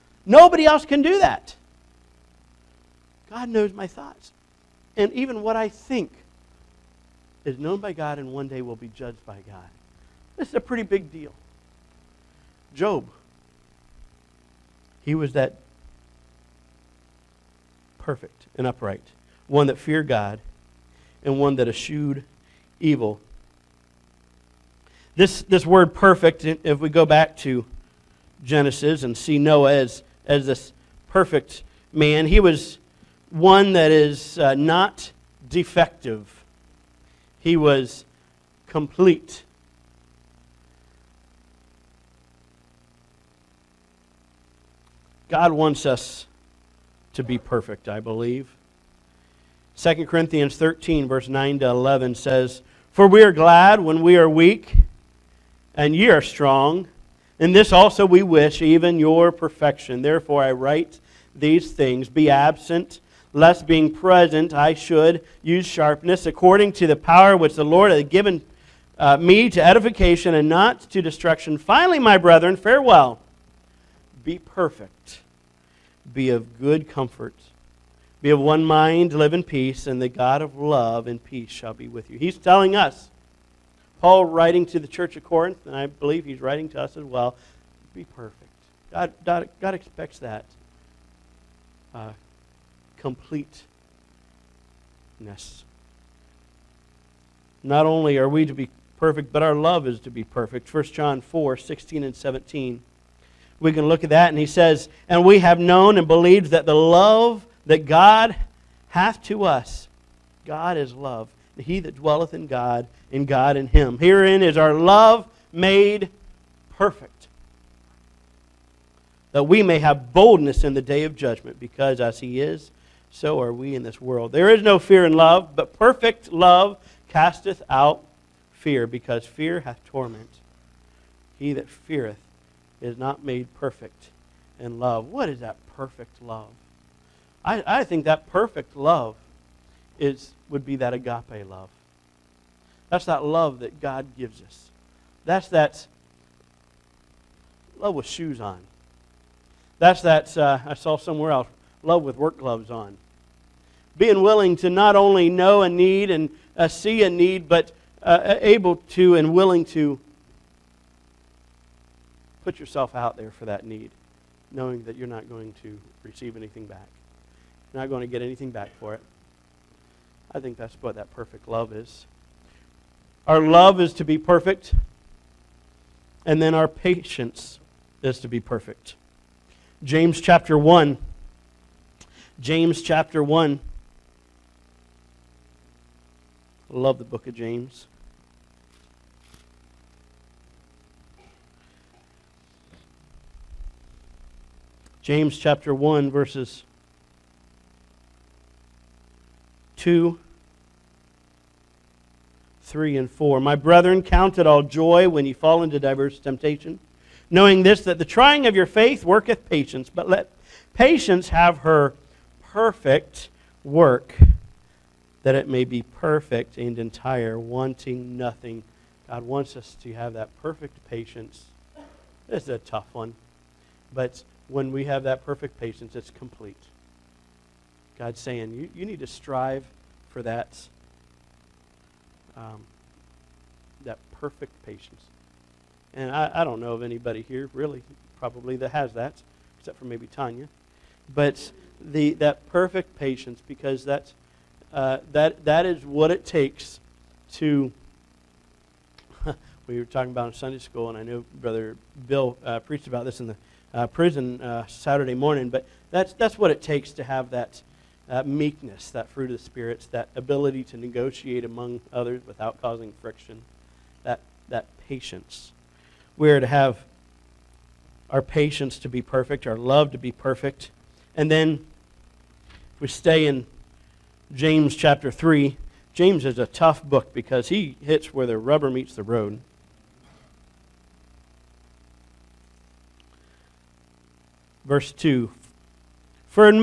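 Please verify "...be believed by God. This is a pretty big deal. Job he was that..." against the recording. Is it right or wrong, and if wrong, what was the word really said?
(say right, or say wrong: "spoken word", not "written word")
wrong: "judged", not "believed".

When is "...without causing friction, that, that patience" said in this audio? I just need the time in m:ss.
4:22.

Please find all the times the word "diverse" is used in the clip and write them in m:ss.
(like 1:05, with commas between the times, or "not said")
3:25.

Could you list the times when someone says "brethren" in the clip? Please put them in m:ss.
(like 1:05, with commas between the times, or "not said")
1:12, 3:23.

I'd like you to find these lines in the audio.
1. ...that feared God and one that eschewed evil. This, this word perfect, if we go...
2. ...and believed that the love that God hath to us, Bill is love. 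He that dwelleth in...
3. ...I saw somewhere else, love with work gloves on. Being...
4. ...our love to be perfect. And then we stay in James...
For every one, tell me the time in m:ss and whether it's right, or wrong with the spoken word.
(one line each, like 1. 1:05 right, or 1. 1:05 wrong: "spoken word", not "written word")
1. 0:19 right
2. 1:45 wrong: "God", not "Bill"
3. 2:30 right
4. 4:29 right.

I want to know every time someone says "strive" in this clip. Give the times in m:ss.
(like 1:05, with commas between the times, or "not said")
3:49.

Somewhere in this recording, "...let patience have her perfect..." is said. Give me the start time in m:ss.
3:30.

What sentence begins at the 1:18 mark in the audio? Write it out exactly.
Be of one mind, live in peace, and the God of love and peace shall be with you.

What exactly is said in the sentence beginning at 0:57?
In this also we wish, even your perfection.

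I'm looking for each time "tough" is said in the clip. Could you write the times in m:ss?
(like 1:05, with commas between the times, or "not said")
3:42, 4:36.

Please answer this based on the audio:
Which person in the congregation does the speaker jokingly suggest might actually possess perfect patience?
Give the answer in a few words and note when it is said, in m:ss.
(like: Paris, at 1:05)
Tanya, at 4:00.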